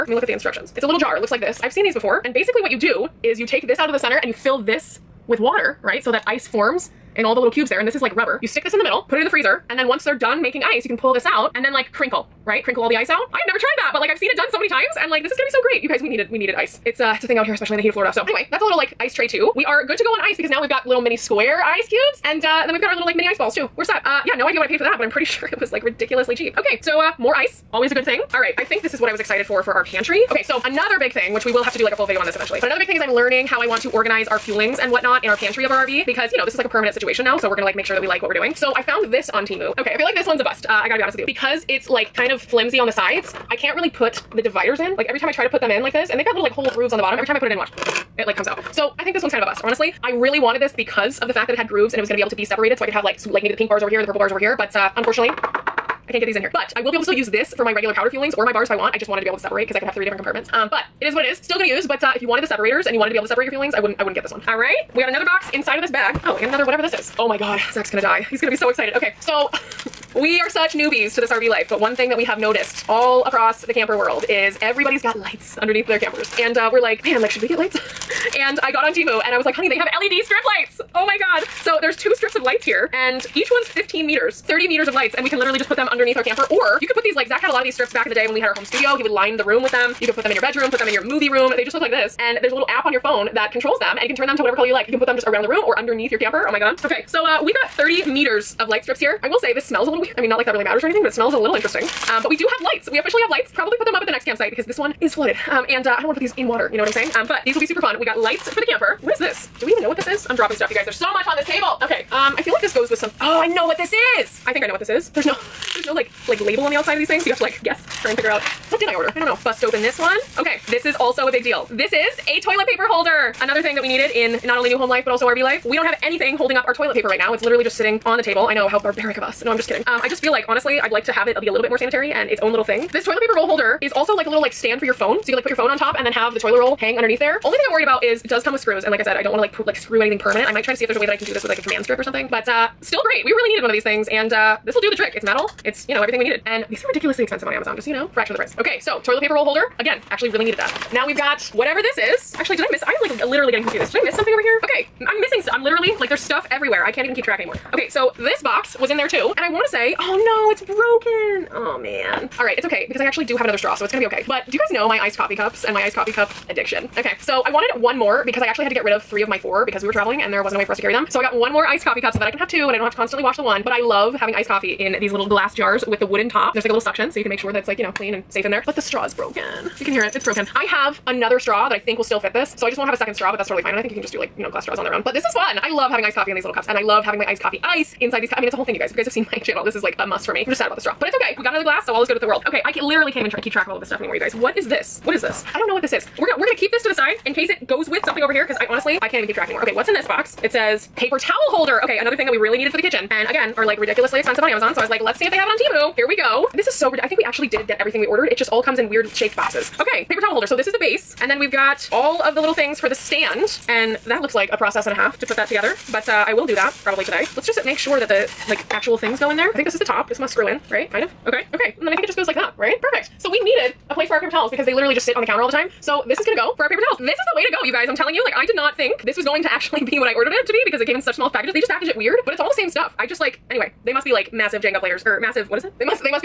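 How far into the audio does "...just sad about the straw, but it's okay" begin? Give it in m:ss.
3:10.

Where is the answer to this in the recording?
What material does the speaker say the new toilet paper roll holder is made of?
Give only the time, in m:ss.
2:25.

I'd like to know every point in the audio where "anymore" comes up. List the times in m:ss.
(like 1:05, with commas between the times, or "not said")
2:37, 3:14, 3:19.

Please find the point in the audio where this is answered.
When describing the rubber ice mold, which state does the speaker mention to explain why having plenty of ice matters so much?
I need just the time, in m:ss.
0:17.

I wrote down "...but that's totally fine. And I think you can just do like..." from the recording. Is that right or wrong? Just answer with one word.
right.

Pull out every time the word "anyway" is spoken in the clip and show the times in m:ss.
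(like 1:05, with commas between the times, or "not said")
0:18, 3:53.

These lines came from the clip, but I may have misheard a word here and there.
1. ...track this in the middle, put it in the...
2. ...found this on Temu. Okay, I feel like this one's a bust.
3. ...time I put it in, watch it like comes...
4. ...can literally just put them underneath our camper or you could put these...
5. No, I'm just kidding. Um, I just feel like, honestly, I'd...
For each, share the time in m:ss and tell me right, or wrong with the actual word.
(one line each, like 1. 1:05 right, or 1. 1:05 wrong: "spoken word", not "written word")
1. 0:08 wrong: "stick", not "track"
2. 0:38 right
3. 0:47 right
4. 1:25 right
5. 2:09 right.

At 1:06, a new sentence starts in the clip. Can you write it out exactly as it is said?
Oh, and another whatever this is.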